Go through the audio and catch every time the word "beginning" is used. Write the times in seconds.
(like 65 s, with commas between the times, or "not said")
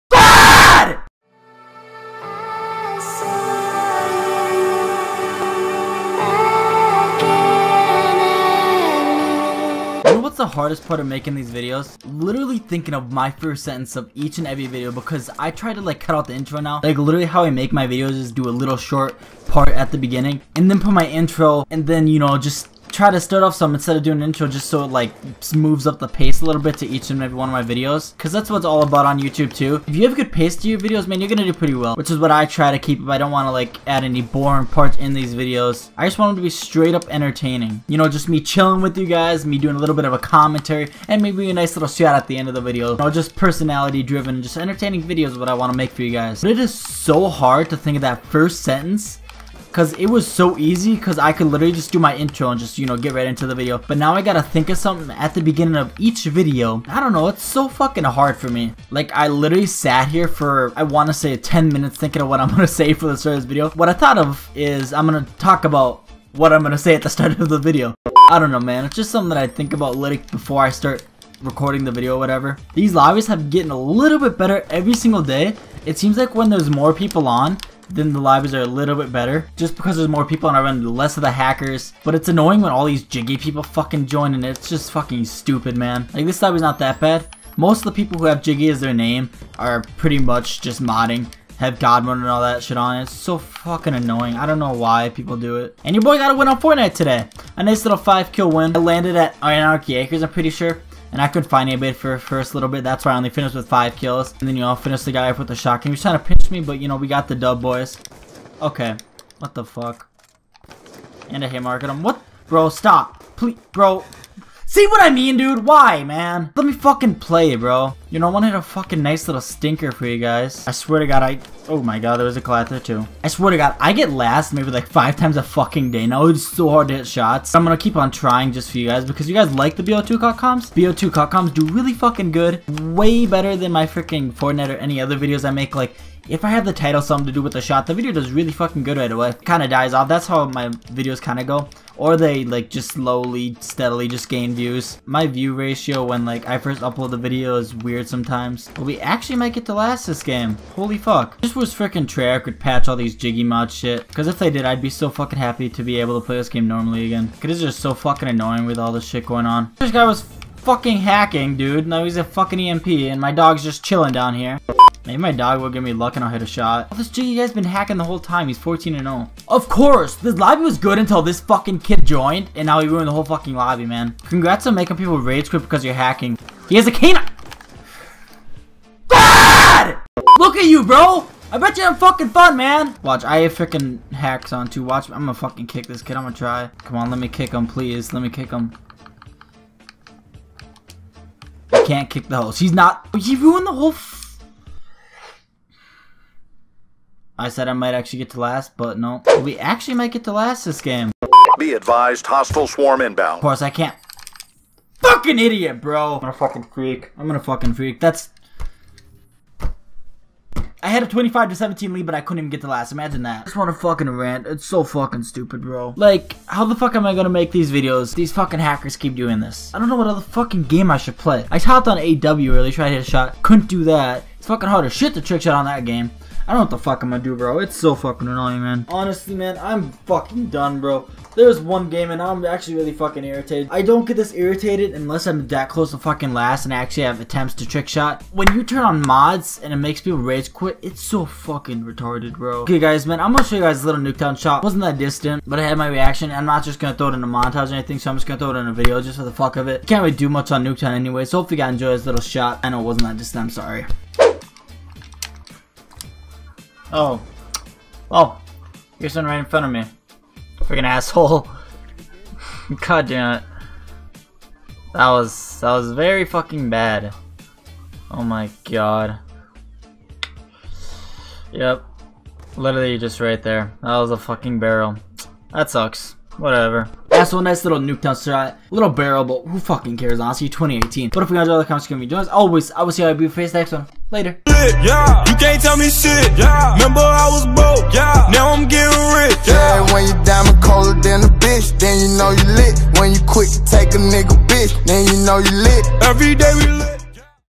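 19 s, 55 s.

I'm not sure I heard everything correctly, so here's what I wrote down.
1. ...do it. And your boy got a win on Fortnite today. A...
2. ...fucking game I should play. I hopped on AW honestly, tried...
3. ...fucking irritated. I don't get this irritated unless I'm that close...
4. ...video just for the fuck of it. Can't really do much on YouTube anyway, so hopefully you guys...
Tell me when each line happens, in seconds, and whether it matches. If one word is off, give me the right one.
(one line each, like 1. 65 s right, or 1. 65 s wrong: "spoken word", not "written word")
1. 95 s right
2. 220 s wrong: "early", not "honestly"
3. 232 s right
4. 248 s wrong: "Nuketown", not "YouTube".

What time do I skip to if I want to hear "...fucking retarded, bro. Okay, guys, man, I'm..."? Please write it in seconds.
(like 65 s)
241 s.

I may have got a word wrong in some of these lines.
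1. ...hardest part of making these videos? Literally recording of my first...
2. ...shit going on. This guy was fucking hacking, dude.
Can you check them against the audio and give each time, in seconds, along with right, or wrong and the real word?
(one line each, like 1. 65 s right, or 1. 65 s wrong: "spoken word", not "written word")
1. 10 s wrong: "thinking", not "recording"
2. 159 s right.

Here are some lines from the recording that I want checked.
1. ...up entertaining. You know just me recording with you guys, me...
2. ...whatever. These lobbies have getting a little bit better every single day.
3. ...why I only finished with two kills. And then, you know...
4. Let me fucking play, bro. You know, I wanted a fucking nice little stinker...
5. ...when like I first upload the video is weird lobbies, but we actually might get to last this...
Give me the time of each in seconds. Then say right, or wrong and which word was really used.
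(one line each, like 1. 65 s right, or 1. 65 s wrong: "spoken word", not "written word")
1. 36 s wrong: "chilling", not "recording"
2. 72 s right
3. 103 s wrong: "five", not "two"
4. 116 s right
5. 146 s wrong: "sometimes", not "lobbies".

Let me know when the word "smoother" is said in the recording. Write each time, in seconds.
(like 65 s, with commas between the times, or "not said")
not said.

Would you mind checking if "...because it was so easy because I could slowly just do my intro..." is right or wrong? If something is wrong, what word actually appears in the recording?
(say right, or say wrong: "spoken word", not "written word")
wrong: "literally", not "slowly".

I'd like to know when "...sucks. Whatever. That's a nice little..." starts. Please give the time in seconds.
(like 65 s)
275 s.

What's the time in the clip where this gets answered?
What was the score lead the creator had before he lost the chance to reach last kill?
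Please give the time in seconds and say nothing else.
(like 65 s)
211 s.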